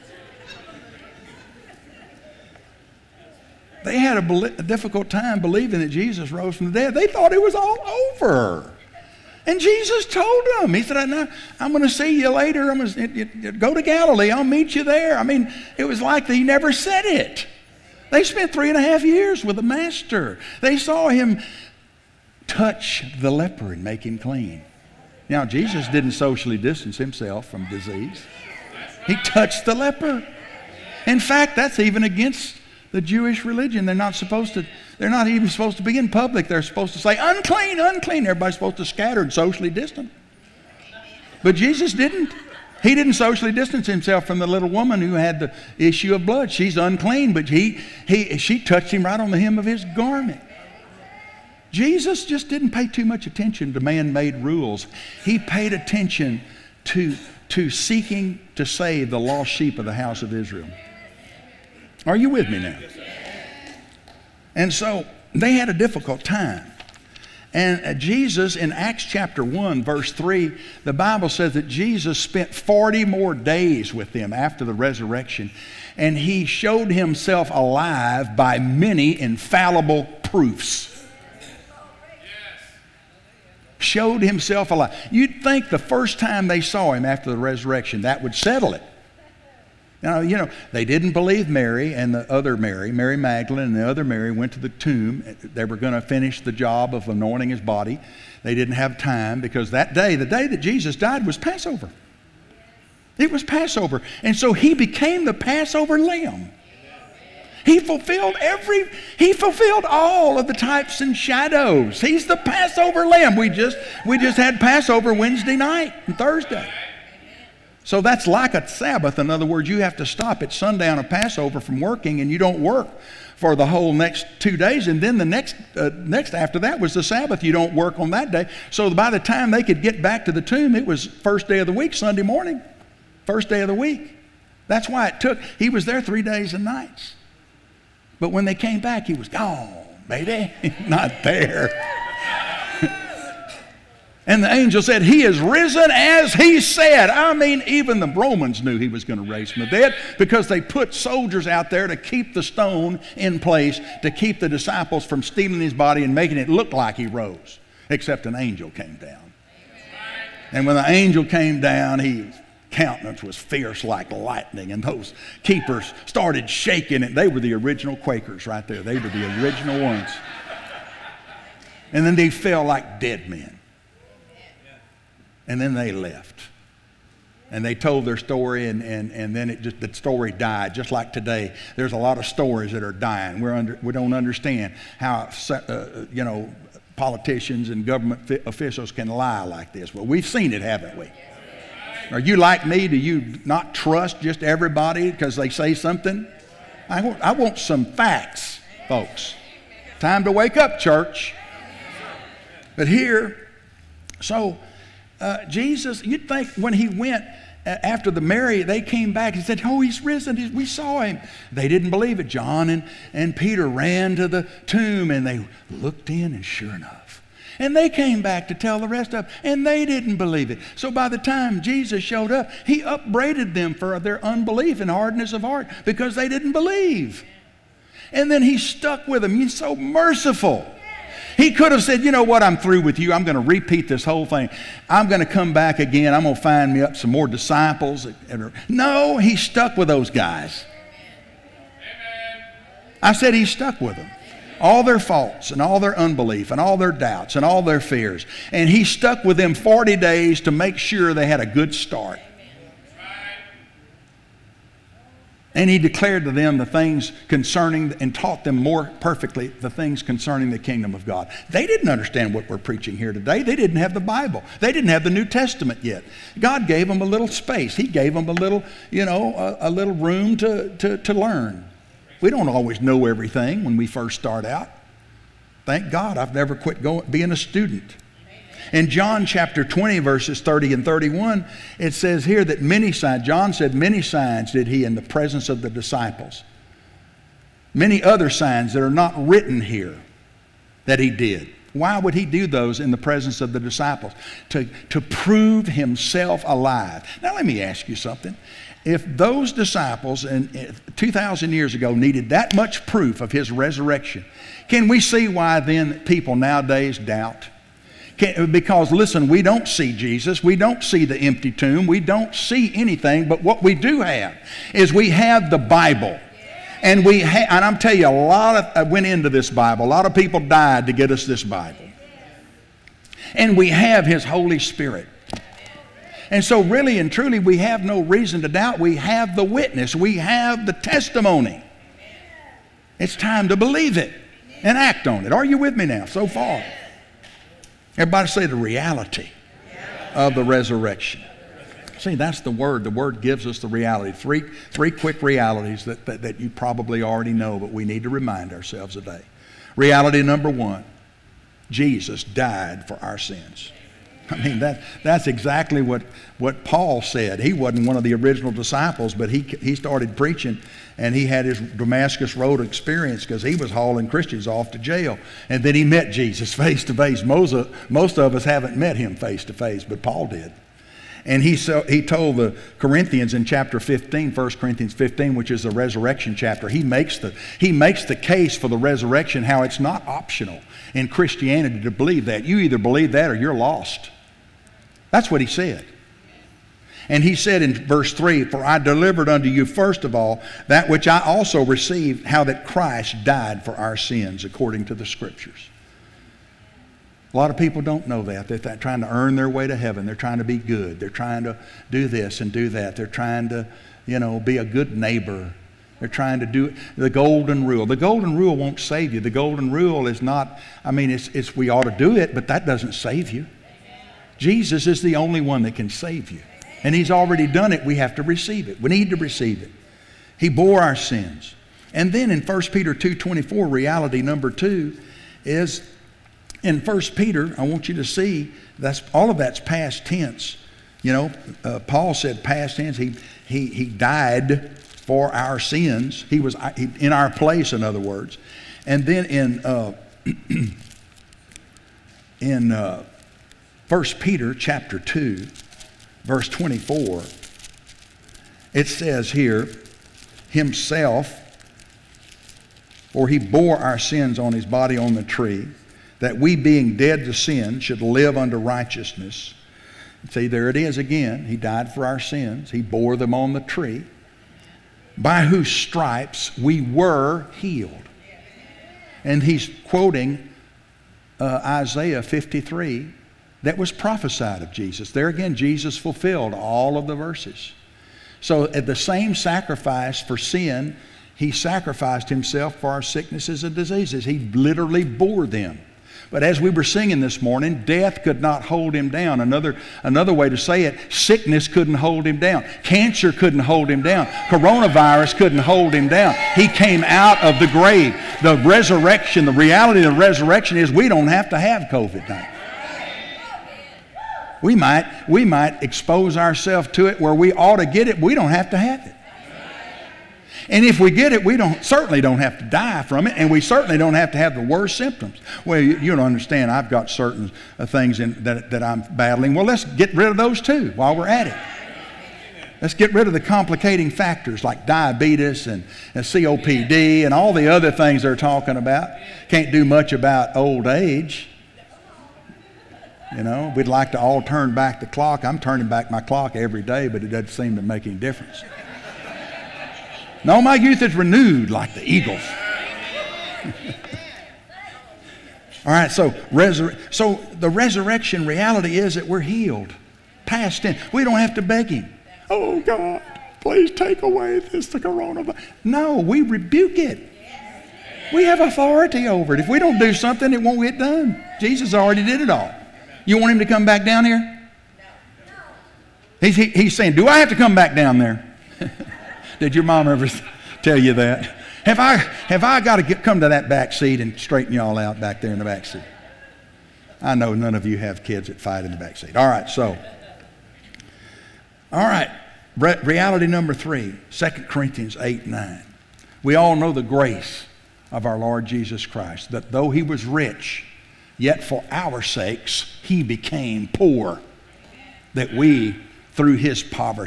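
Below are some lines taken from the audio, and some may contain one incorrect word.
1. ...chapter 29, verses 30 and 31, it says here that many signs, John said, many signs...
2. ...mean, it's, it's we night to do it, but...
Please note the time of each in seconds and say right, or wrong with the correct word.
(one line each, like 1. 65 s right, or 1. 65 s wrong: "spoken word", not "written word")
1. 279 s wrong: "20", not "29"
2. 410 s wrong: "ought", not "night".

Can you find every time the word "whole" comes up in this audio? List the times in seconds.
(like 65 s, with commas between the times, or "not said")
123 s, 234 s.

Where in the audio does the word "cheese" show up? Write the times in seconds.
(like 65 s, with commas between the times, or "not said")
not said.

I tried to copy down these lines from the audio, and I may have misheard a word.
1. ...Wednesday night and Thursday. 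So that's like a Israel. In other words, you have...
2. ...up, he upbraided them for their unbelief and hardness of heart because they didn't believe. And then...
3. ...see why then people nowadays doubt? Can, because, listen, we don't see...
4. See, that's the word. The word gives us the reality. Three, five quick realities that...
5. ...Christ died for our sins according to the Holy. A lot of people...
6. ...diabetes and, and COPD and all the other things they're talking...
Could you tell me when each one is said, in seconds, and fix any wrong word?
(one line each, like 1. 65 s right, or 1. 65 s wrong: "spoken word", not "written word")
1. 115 s wrong: "Sabbath", not "Israel"
2. 222 s right
3. 304 s right
4. 341 s wrong: "three", not "five"
5. 392 s wrong: "Scriptures", not "Holy"
6. 524 s right.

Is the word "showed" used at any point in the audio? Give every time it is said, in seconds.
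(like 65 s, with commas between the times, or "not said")
76 s, 83 s, 222 s.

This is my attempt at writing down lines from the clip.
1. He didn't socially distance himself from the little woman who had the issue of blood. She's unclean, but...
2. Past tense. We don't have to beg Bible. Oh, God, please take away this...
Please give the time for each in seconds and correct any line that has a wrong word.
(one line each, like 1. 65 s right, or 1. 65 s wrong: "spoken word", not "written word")
1. 42 s right
2. 550 s wrong: "Him", not "Bible".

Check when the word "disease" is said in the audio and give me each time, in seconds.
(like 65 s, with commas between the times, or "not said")
27 s, 483 s.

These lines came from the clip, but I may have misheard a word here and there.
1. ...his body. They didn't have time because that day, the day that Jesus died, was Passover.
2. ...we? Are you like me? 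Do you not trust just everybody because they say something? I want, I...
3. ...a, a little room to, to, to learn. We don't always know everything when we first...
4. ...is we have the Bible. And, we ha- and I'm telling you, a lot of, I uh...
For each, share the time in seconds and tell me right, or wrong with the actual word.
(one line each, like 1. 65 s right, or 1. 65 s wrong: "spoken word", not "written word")
1. 97 s right
2. 190 s right
3. 269 s right
4. 314 s right.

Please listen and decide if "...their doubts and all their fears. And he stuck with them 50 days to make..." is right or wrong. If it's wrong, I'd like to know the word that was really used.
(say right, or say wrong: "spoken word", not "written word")
wrong: "40", not "50".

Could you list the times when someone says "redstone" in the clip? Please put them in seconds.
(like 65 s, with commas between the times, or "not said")
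not said.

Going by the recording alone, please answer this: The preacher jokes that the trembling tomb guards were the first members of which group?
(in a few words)
Quakers.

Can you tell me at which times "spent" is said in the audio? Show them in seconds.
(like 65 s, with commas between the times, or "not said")
18 s, 72 s.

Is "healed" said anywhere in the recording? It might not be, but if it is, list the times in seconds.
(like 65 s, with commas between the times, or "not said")
467 s, 549 s.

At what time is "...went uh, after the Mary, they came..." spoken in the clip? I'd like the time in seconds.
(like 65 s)
206 s.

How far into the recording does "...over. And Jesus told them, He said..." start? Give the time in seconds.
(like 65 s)
8 s.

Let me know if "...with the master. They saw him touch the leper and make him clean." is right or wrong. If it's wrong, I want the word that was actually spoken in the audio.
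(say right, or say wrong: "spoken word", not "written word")
right.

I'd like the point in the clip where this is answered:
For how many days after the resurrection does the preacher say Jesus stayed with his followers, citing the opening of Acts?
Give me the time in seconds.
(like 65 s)
72 s.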